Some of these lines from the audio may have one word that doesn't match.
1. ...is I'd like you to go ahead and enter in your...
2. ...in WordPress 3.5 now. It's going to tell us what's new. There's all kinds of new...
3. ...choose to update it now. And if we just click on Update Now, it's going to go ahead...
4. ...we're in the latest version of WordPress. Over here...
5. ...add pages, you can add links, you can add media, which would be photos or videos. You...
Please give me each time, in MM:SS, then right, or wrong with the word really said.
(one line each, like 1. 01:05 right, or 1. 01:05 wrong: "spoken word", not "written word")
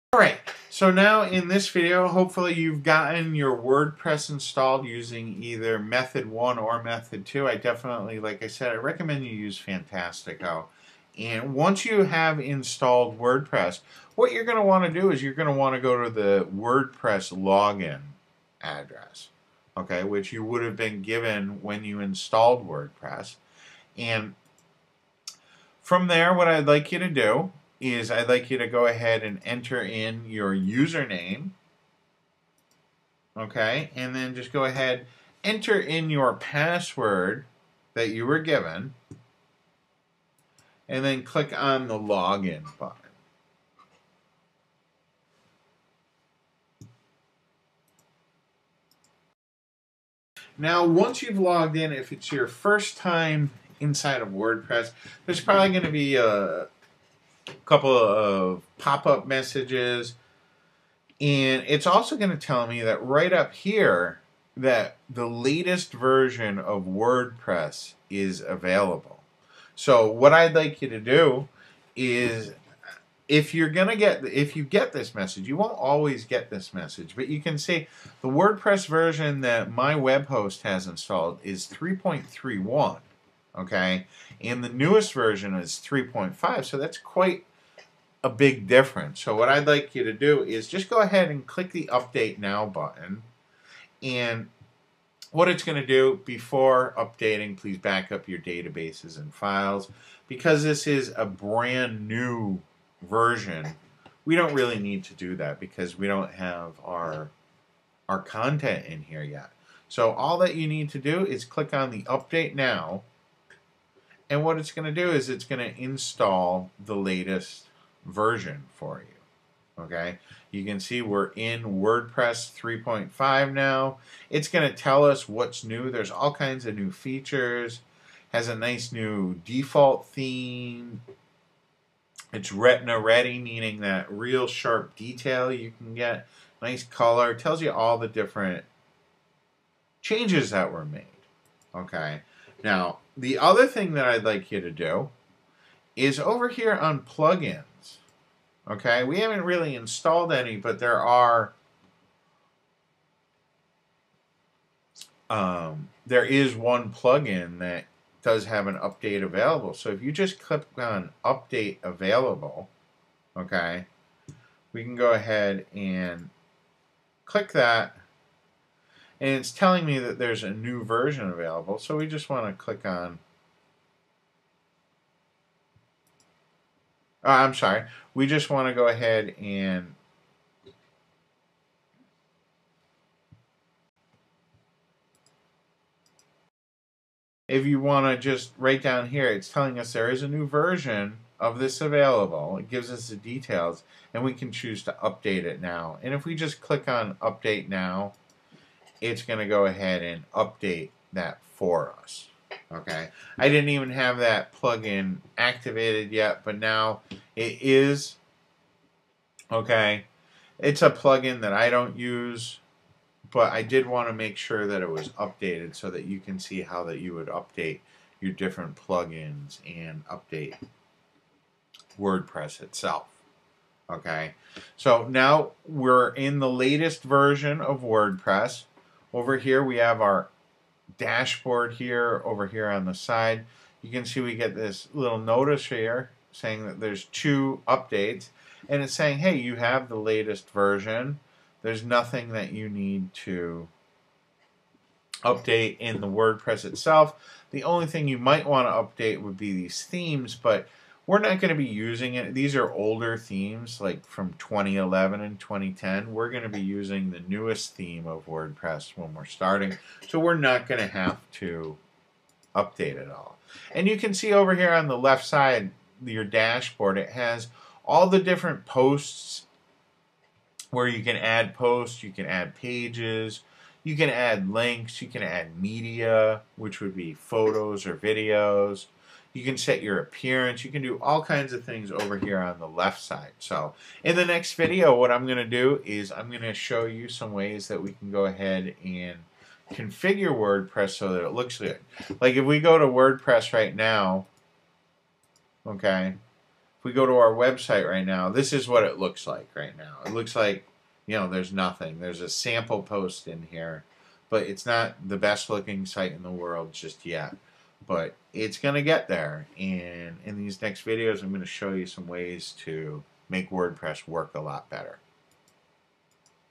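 1. 00:27 right
2. 02:01 right
3. 03:14 right
4. 03:45 right
5. 04:32 right.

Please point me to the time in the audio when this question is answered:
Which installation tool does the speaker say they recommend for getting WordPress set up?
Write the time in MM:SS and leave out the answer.
00:09.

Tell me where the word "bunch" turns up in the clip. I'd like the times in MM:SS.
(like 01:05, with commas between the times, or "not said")
not said.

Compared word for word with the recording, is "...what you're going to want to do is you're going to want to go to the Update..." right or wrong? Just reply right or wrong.
wrong.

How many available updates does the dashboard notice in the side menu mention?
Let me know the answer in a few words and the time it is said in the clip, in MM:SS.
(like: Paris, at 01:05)
2, at 03:57.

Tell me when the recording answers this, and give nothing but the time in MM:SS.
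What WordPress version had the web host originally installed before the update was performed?
01:21.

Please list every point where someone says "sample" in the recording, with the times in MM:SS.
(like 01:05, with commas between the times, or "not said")
05:02.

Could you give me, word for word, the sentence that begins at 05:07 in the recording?
But it's going to get there.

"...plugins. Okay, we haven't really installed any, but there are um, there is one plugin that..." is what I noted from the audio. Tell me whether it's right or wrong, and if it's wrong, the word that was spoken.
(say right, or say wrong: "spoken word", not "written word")
right.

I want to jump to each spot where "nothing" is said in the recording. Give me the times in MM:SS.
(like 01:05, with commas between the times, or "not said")
04:01, 05:01.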